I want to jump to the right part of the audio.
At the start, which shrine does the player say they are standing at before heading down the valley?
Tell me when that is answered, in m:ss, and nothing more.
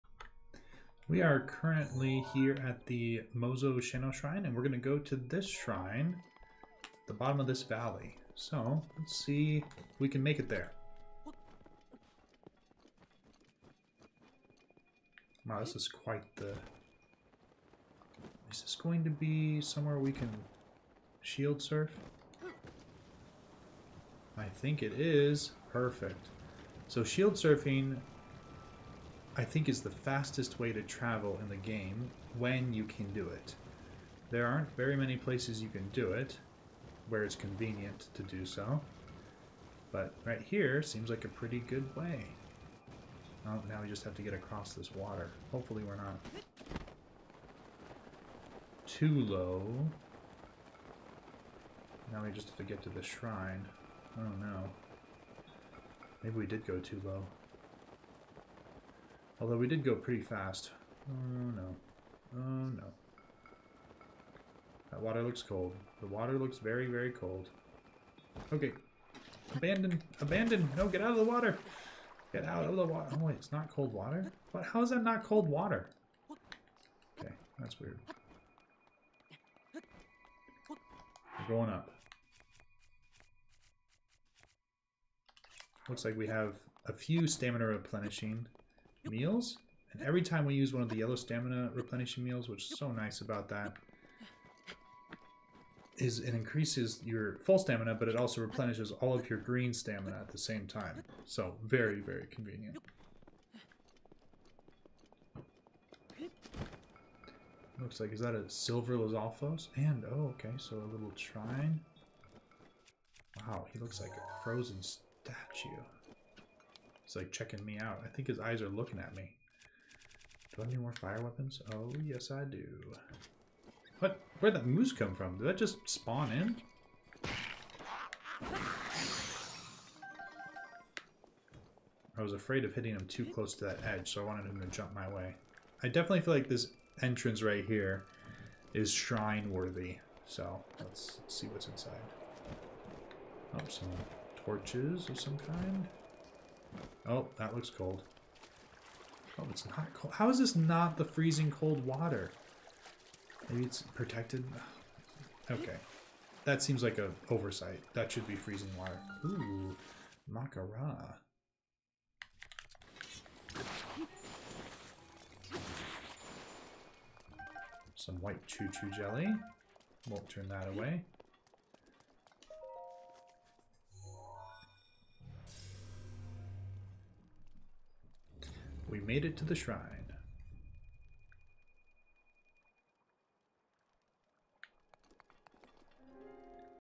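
0:03.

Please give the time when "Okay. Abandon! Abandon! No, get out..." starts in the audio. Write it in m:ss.
1:08.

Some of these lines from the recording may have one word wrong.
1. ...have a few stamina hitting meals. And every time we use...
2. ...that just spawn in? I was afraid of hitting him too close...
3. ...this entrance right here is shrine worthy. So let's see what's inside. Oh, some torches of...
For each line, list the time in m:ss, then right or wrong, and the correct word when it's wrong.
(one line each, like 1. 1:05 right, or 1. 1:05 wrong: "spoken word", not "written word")
1. 1:26 wrong: "replenishing", not "hitting"
2. 2:05 right
3. 2:16 right.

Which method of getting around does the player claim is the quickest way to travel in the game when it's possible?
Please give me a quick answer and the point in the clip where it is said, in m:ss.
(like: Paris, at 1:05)
Shield surfing, at 0:27.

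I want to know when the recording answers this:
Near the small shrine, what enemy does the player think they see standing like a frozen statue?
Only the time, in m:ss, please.
1:48.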